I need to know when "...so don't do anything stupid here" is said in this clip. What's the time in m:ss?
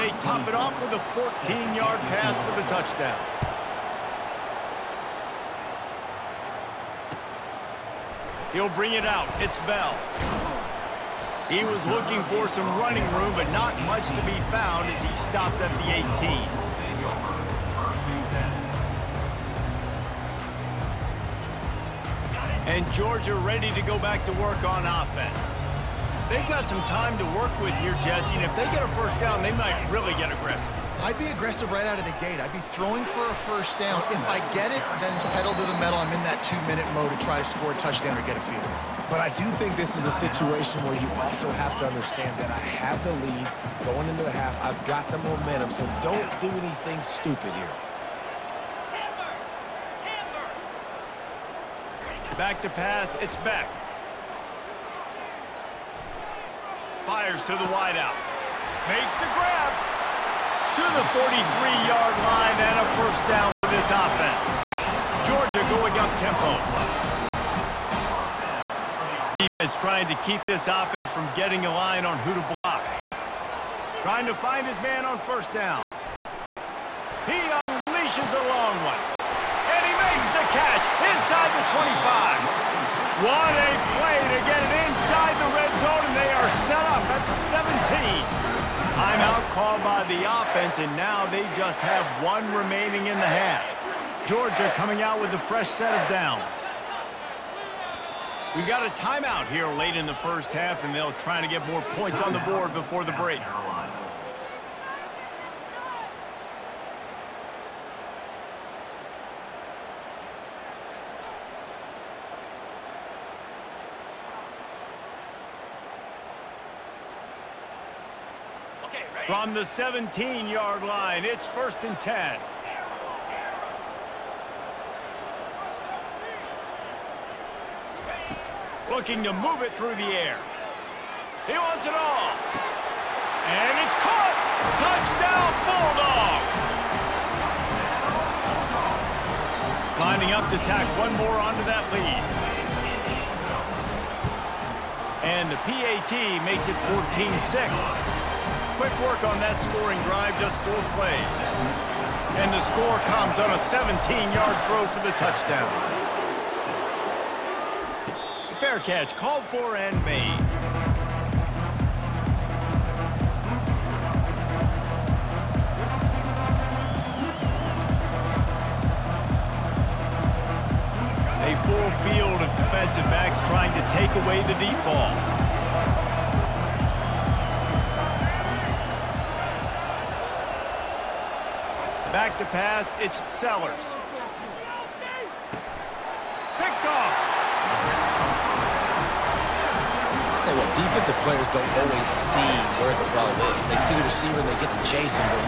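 0:45.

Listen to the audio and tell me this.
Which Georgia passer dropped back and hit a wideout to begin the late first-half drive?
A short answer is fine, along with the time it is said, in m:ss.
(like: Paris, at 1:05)
Beck, at 0:53.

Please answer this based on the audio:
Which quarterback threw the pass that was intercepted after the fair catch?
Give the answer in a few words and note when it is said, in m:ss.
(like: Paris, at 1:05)
Sellers, at 3:03.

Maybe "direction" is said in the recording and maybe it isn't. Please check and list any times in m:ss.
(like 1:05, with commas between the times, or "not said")
not said.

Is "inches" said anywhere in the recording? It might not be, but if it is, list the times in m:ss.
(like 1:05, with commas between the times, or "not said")
not said.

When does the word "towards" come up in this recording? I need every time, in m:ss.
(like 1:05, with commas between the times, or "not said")
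not said.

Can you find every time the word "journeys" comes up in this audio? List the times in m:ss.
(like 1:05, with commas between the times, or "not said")
not said.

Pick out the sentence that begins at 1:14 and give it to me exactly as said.
Trying to find his man on first down.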